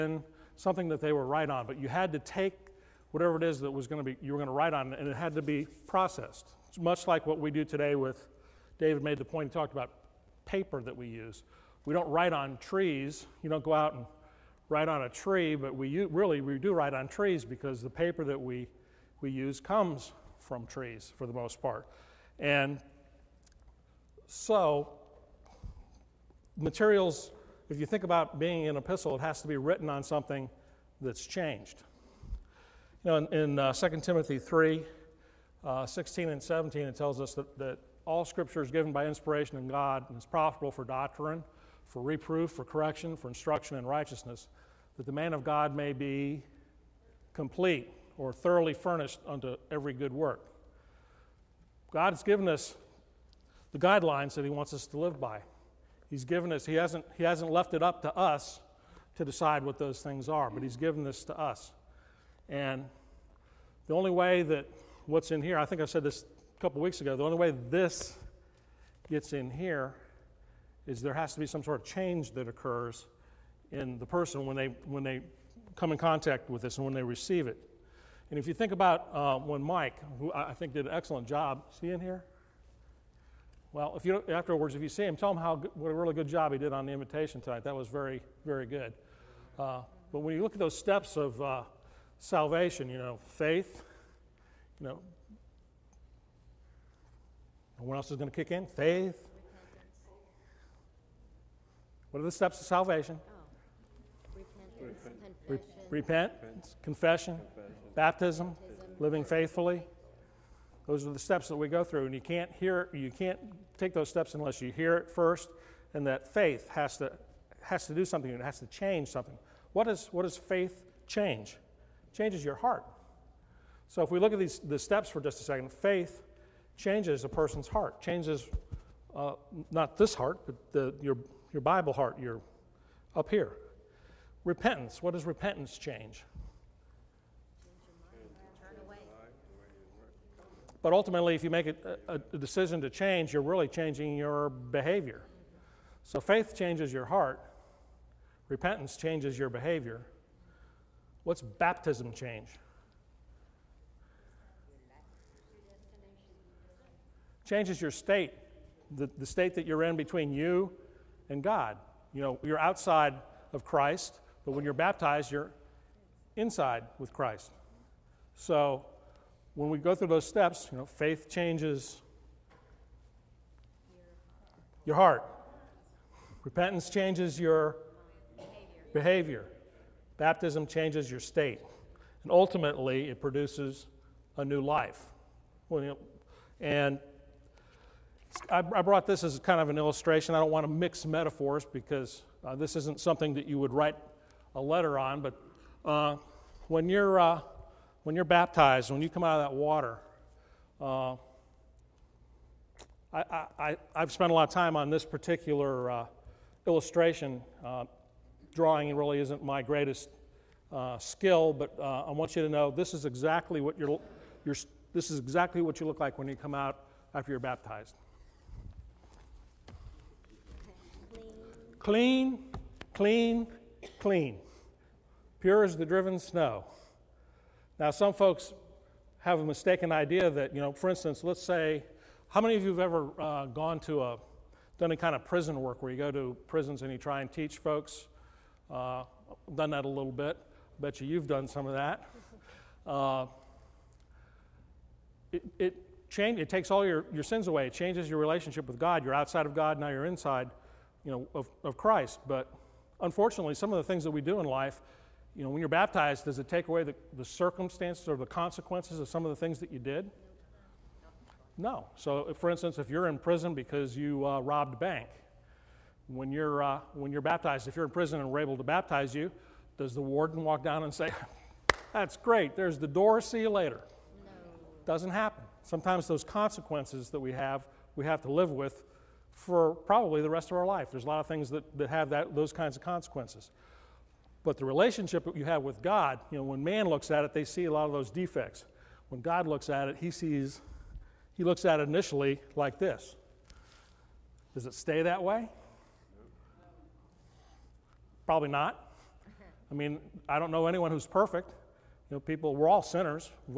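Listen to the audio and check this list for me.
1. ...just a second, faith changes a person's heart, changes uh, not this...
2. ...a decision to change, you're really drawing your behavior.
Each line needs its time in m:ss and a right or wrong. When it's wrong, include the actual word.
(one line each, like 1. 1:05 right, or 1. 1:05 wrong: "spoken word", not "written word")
1. 2:05 right
2. 2:22 wrong: "changing", not "drawing".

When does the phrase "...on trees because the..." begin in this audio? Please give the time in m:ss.
0:16.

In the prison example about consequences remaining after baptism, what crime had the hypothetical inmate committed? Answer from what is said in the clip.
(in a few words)
Robbed a bank.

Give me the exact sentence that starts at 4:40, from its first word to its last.
There's a lot of things that, that have that, those kinds of consequences.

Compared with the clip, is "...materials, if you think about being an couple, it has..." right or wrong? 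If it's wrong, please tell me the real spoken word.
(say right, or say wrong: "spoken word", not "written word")
wrong: "epistle", not "couple".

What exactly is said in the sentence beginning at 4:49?
When God looks at it, he sees, he looks at it initially like this.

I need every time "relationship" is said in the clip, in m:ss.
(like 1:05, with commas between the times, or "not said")
4:08, 4:44.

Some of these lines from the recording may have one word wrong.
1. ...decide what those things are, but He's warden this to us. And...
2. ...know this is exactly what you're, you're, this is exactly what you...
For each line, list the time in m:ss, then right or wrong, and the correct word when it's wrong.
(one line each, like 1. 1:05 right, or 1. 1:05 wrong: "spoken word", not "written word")
1. 0:59 wrong: "given", not "warden"
2. 3:32 right.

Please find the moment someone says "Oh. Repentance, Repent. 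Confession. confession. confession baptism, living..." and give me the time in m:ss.
1:44.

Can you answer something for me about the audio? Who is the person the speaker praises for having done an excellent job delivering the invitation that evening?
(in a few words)
Mike.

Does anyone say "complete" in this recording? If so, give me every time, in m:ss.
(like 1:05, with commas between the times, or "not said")
0:47.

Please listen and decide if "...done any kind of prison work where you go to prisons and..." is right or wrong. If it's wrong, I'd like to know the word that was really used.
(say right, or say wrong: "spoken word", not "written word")
right.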